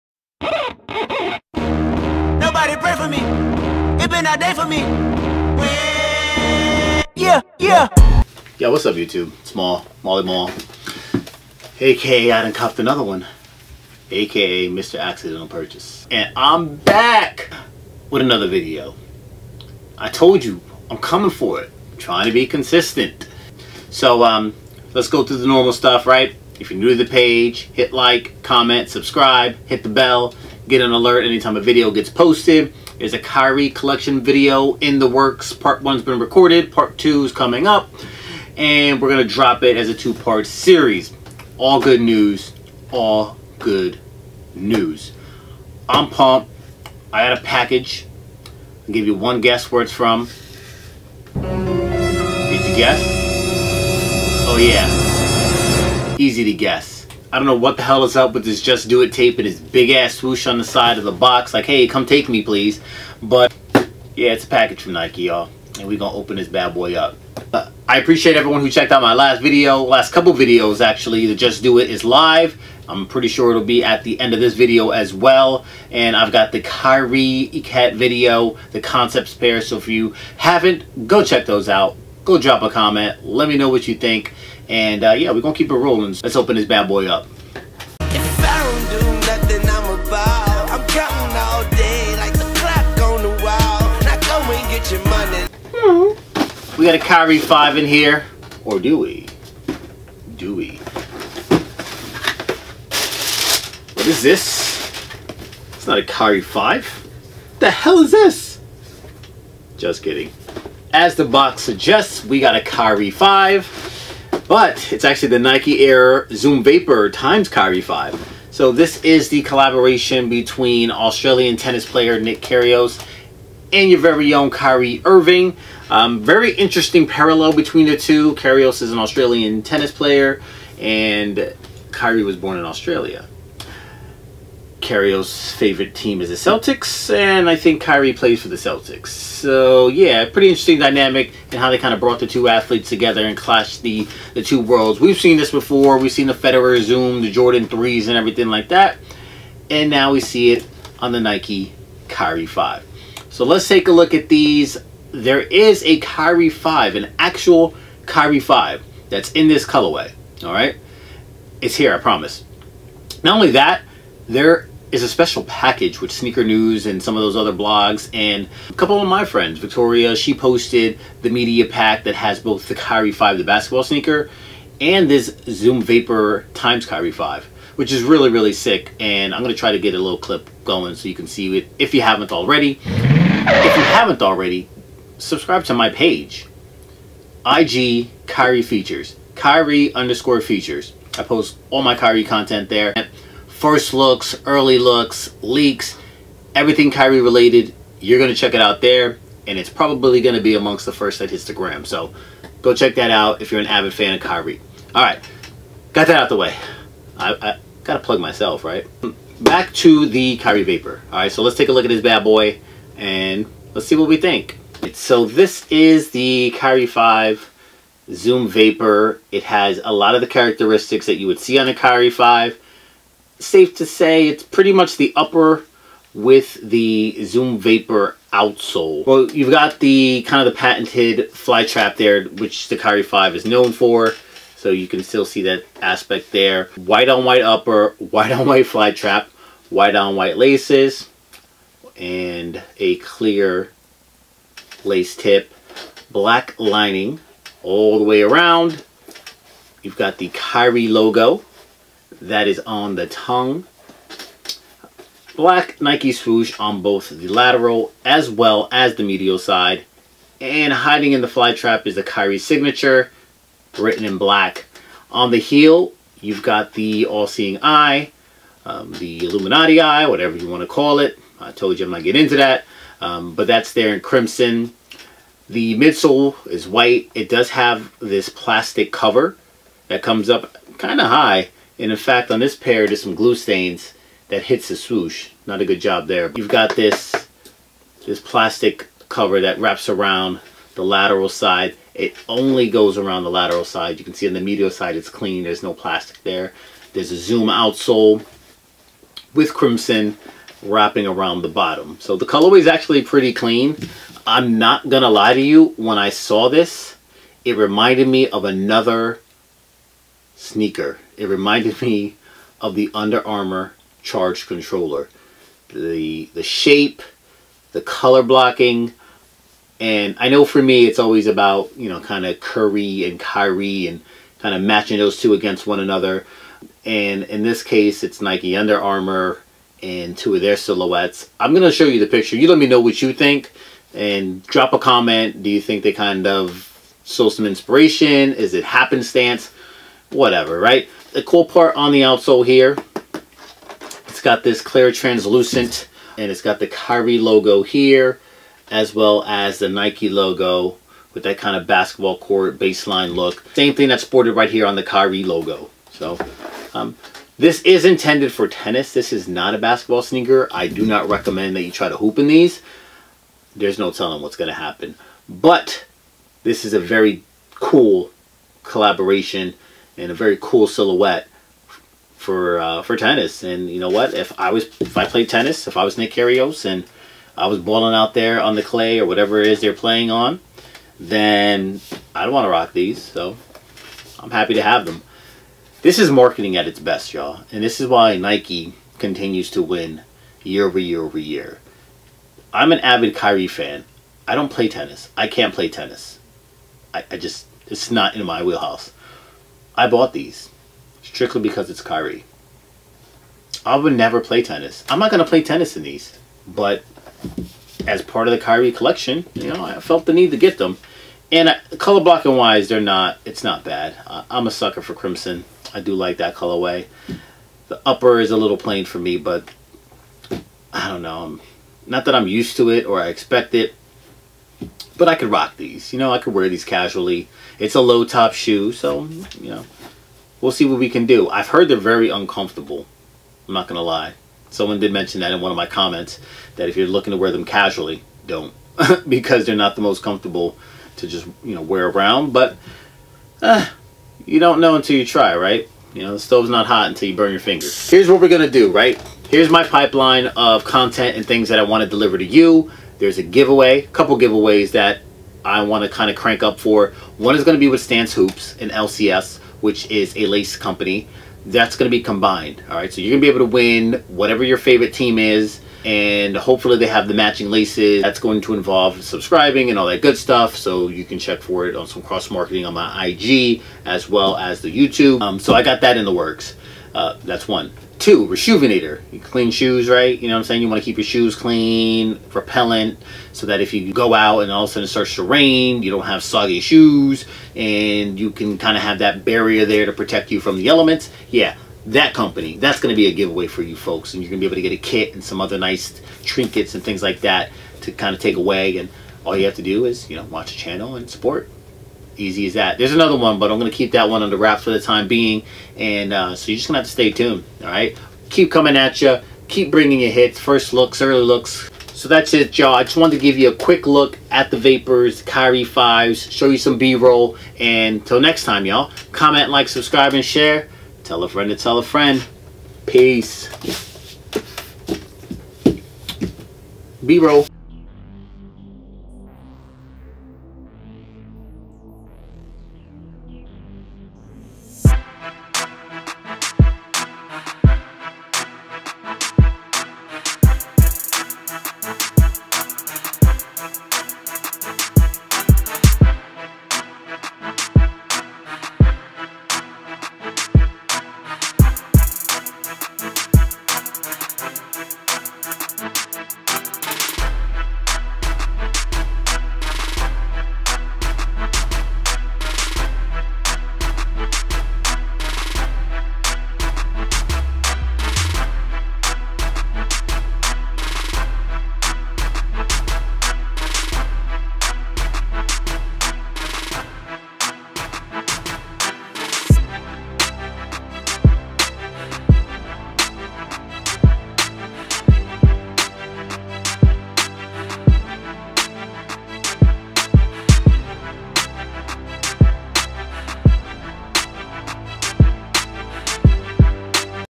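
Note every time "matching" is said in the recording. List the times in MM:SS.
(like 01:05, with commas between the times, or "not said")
05:24, 07:47.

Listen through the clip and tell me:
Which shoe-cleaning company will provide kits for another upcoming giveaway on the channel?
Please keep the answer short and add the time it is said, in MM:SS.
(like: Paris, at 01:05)
Reshoevn8r, at 07:58.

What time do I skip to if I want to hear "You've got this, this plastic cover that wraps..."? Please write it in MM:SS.
04:46.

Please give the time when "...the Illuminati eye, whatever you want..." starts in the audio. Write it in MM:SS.
04:28.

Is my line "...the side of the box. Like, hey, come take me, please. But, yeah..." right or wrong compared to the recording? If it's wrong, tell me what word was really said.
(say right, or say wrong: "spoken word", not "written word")
right.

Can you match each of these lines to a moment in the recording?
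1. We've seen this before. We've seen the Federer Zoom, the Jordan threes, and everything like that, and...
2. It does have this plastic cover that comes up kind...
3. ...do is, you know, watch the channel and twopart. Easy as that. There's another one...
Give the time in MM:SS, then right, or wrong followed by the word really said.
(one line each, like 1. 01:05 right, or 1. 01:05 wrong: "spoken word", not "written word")
1. 02:24 right
2. 04:37 right
3. 08:19 wrong: "support", not "twopart".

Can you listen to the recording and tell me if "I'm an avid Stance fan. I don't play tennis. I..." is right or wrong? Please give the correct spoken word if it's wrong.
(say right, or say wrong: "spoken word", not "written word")
wrong: "Kyrie", not "Stance".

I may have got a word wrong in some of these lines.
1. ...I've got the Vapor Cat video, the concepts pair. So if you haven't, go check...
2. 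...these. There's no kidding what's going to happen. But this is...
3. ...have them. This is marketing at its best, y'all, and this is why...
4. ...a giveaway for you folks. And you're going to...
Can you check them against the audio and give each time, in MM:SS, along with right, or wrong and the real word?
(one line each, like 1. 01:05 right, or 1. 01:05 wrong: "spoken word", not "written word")
1. 01:16 wrong: "Kyrie", not "Vapor"
2. 06:02 wrong: "telling", not "kidding"
3. 06:24 right
4. 08:13 right.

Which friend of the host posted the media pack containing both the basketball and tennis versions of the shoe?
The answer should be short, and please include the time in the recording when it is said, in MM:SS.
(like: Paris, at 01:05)
Victoria, at 02:49.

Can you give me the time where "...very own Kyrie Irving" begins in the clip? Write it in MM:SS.
02:04.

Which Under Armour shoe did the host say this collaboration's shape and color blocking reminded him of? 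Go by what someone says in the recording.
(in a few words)
Charge Controller.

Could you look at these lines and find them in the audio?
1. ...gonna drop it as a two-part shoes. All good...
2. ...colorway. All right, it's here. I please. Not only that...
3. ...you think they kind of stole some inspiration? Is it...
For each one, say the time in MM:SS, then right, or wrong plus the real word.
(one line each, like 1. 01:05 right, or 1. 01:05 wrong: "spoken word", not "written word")
1. 00:39 wrong: "series", not "shoes"
2. 02:39 wrong: "promise", not "please"
3. 05:35 right.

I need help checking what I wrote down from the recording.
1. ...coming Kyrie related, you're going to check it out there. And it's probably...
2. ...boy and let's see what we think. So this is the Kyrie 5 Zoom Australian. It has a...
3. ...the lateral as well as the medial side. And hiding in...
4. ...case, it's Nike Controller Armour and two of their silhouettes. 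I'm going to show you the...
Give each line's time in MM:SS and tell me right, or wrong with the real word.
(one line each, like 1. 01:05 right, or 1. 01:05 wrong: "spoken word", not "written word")
1. 03:16 wrong: "everything", not "coming"
2. 03:32 wrong: "Vapor", not "Australian"
3. 04:17 right
4. 05:27 wrong: "Under", not "Controller".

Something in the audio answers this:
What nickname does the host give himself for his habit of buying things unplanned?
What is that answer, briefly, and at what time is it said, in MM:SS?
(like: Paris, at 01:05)
Mr. Accidental Purchase, at 00:14.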